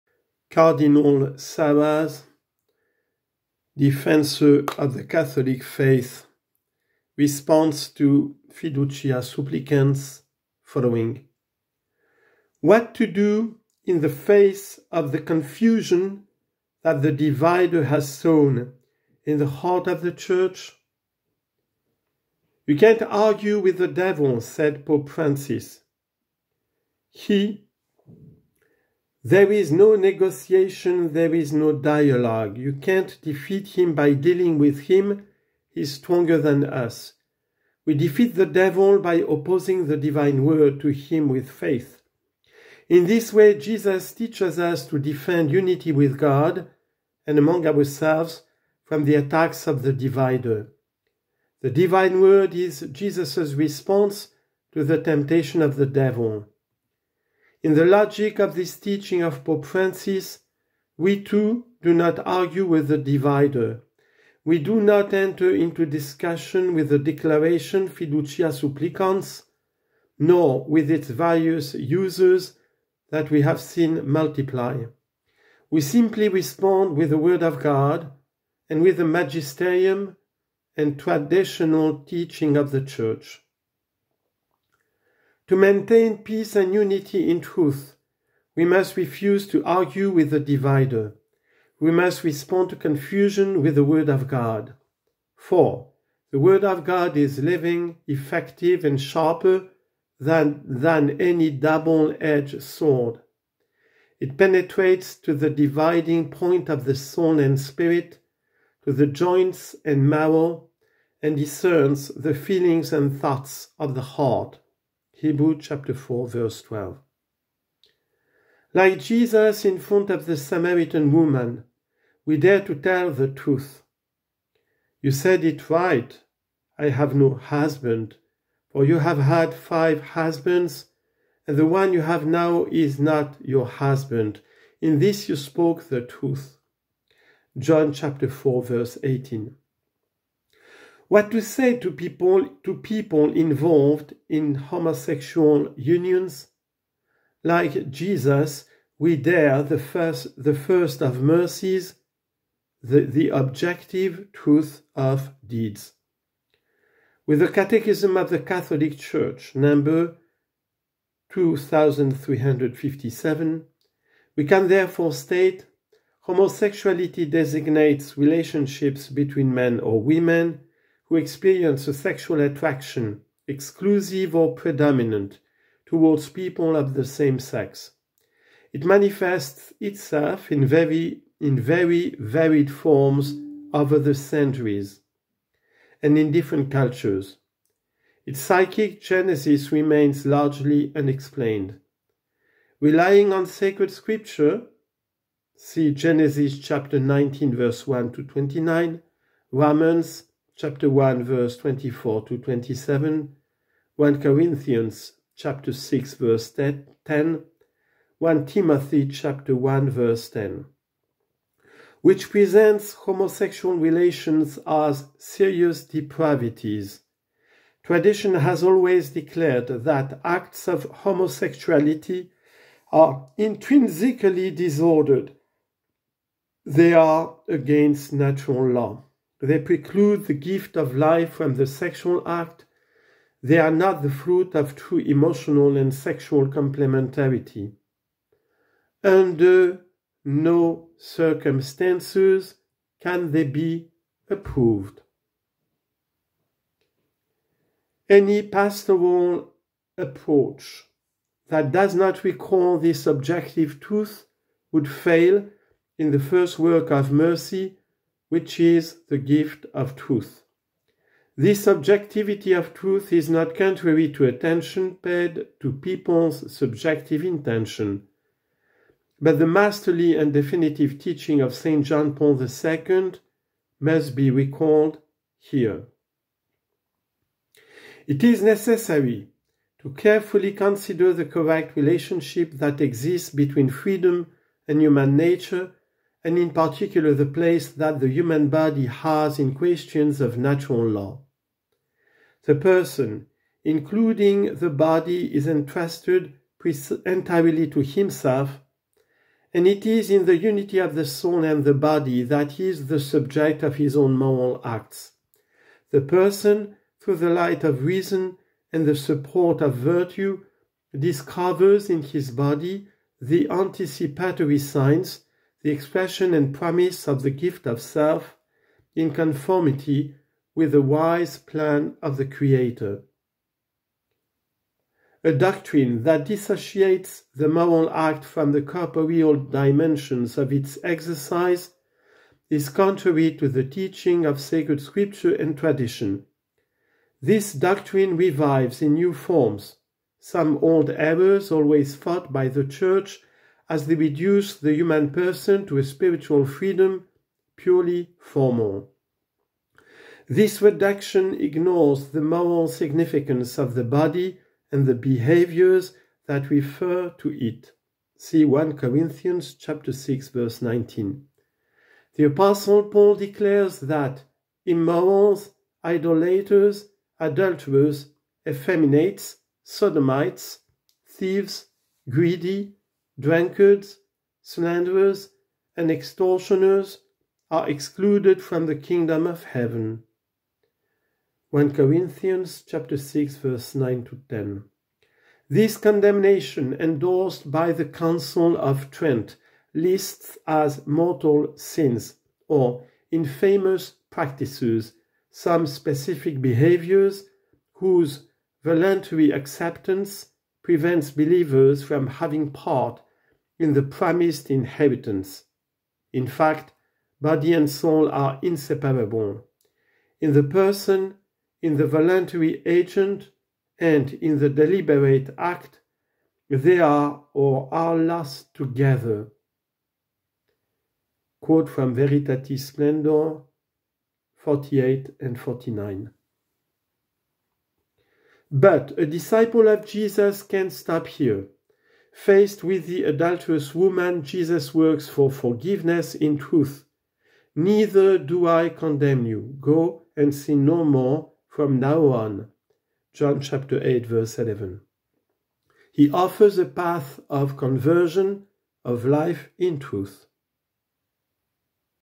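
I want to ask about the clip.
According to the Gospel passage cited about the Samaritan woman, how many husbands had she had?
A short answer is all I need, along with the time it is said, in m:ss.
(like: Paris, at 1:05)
5, at 2:09.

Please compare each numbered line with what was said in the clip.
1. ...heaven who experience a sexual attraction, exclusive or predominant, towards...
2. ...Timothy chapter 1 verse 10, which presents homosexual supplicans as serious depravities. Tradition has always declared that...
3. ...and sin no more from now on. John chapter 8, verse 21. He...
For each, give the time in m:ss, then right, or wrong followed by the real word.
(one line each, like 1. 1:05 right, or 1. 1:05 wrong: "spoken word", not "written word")
1. 2:50 wrong: "women", not "heaven"
2. 3:28 wrong: "relations", not "supplicans"
3. 7:20 wrong: "11", not "21".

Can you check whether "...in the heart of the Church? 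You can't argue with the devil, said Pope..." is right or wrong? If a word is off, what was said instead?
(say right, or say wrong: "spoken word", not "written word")
right.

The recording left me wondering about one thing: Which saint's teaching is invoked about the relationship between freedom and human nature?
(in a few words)
St. John Paul II.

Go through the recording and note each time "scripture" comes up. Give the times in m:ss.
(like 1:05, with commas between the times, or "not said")
3:13, 5:34.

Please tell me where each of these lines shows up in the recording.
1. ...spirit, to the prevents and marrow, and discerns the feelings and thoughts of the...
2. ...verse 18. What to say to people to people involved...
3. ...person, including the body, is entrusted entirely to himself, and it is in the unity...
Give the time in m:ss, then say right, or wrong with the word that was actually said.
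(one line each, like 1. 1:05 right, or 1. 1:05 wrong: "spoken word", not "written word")
1. 1:47 wrong: "joints", not "prevents"
2. 2:18 right
3. 4:52 right.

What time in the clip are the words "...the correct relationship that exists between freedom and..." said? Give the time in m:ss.
4:41.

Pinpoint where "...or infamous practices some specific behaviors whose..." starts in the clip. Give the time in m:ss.
6:32.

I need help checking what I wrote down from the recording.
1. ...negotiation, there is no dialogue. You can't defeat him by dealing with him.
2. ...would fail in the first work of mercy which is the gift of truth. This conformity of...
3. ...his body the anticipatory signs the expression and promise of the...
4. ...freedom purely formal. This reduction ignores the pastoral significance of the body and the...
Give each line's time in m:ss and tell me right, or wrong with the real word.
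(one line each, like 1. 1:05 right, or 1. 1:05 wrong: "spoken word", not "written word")
1. 0:29 right
2. 4:14 wrong: "subjectivity", not "conformity"
3. 5:12 right
4. 5:46 wrong: "moral", not "pastoral".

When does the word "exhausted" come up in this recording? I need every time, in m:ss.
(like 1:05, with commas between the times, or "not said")
not said.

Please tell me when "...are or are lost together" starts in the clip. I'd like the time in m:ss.
6:56.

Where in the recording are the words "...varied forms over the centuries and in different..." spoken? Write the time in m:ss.
3:02.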